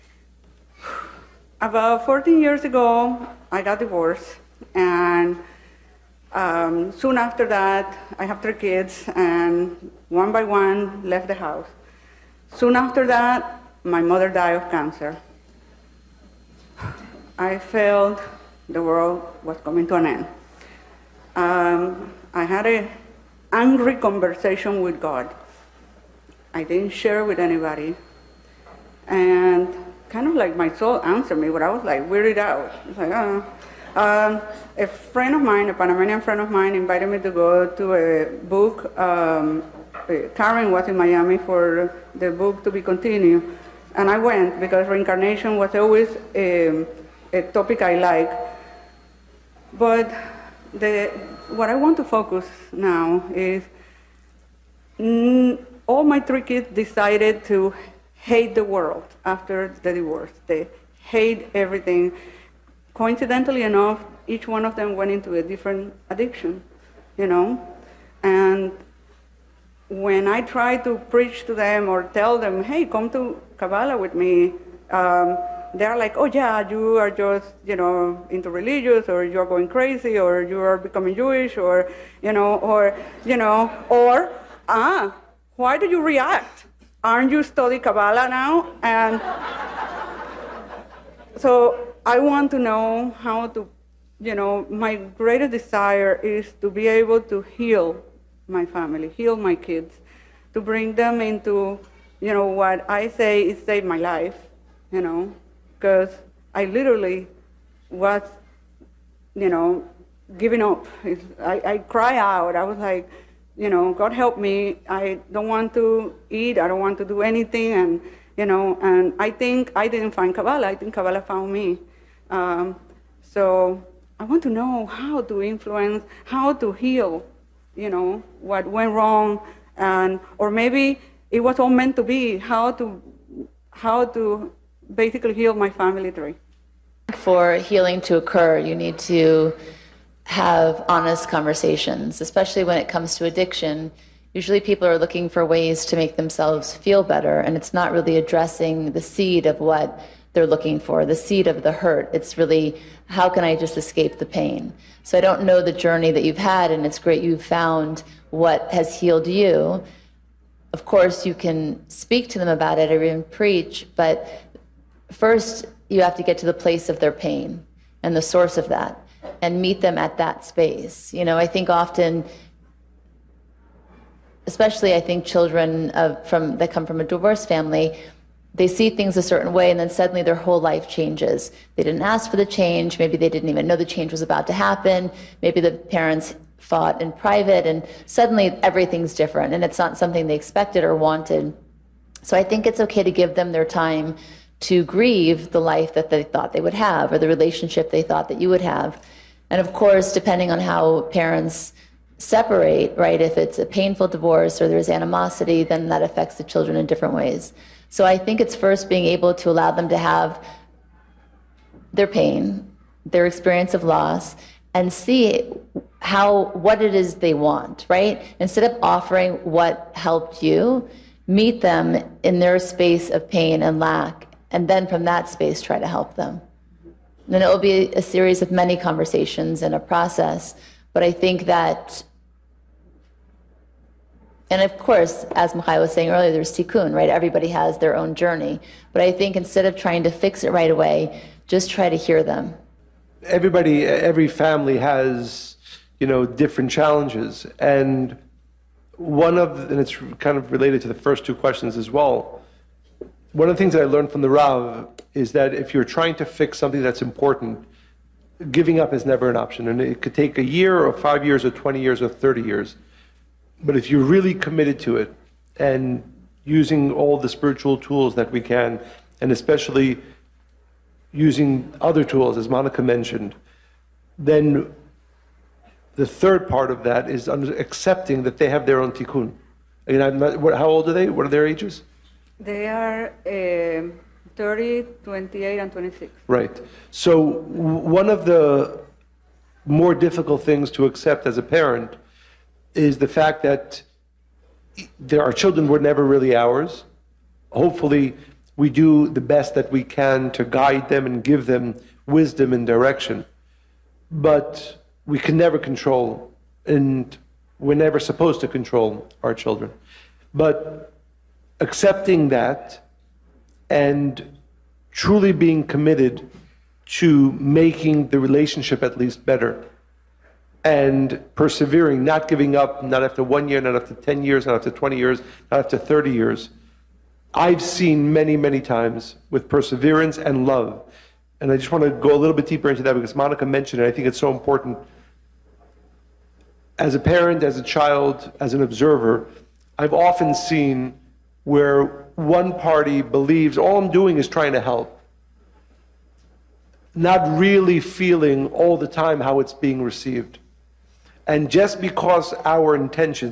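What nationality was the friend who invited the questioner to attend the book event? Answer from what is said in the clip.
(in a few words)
Panamanian.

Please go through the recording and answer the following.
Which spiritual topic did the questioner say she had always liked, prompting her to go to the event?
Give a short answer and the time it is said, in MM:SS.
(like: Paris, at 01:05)
Reincarnation, at 00:44.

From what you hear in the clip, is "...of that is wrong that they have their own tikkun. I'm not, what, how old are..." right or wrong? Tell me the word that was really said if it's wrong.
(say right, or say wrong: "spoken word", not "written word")
wrong: "accepting", not "wrong".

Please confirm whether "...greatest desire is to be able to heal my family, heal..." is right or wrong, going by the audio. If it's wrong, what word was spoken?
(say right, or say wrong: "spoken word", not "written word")
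right.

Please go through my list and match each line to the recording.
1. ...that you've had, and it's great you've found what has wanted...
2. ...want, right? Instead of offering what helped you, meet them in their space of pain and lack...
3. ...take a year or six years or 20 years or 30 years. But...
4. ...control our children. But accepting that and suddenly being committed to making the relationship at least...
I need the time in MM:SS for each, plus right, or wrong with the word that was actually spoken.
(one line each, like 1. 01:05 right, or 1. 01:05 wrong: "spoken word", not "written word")
1. 02:36 wrong: "healed", not "wanted"
2. 03:37 right
3. 04:20 wrong: "five", not "six"
4. 05:08 wrong: "truly", not "suddenly".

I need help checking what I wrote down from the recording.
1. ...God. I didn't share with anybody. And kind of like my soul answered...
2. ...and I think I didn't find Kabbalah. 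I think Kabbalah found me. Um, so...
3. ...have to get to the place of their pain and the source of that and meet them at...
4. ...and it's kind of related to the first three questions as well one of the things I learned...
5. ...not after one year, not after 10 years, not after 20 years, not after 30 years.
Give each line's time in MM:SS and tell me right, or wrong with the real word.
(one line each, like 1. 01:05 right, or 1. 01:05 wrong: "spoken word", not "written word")
1. 00:25 right
2. 01:58 right
3. 02:46 right
4. 04:09 wrong: "two", not "three"
5. 05:22 right.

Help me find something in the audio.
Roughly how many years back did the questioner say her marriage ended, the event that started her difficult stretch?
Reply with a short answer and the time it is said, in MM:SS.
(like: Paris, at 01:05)
14 years, at 00:02.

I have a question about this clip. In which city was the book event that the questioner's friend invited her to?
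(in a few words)
Miami.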